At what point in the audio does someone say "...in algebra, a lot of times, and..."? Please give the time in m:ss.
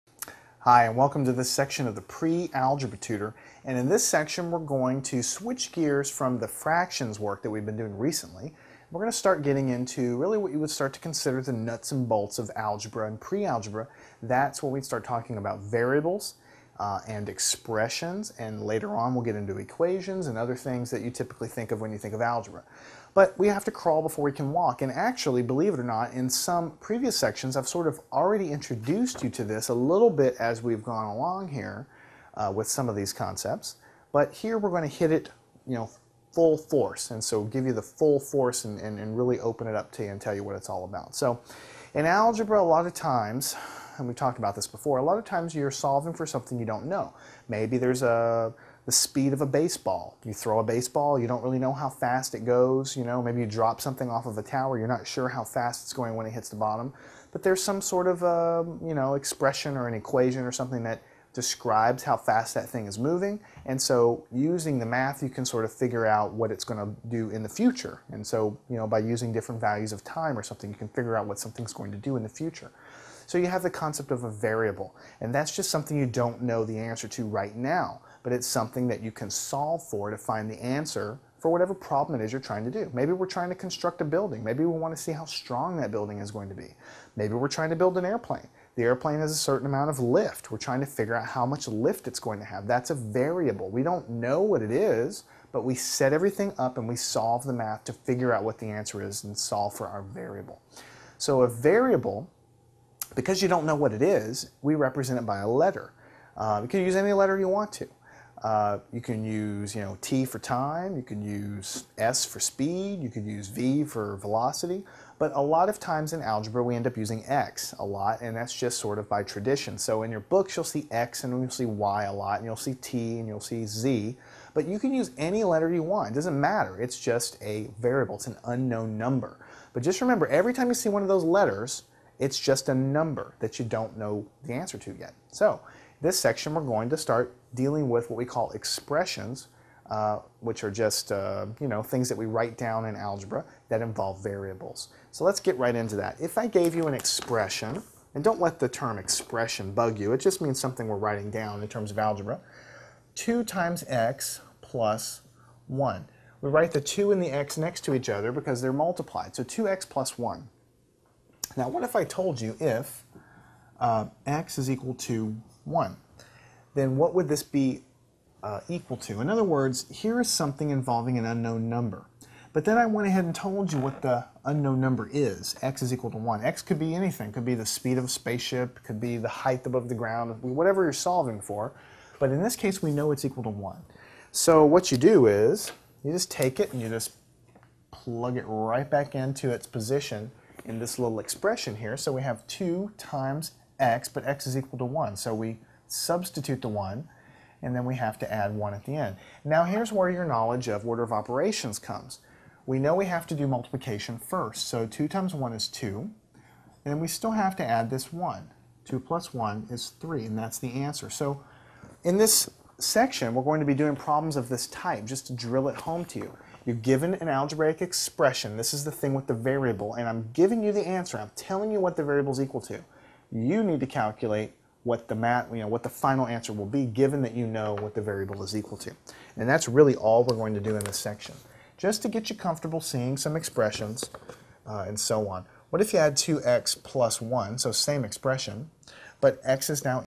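0:41.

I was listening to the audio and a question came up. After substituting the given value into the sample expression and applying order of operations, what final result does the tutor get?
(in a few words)
3.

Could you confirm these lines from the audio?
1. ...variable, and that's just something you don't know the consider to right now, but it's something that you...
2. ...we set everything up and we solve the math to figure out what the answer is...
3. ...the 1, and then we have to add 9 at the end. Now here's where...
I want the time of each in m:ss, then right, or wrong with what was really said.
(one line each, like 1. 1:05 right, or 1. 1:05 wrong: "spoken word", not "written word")
1. 1:14 wrong: "answer", not "consider"
2. 1:35 right
3. 3:16 wrong: "1", not "9".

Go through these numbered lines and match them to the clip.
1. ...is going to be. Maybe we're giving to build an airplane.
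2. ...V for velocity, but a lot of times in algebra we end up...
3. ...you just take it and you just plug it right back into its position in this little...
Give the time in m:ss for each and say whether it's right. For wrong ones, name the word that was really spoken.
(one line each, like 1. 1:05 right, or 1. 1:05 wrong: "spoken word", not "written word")
1. 1:26 wrong: "trying", not "giving"
2. 1:53 right
3. 3:06 right.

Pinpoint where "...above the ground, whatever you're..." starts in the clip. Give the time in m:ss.
2:59.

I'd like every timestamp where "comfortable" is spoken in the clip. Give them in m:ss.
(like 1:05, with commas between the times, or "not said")
3:52.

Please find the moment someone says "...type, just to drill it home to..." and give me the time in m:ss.
3:34.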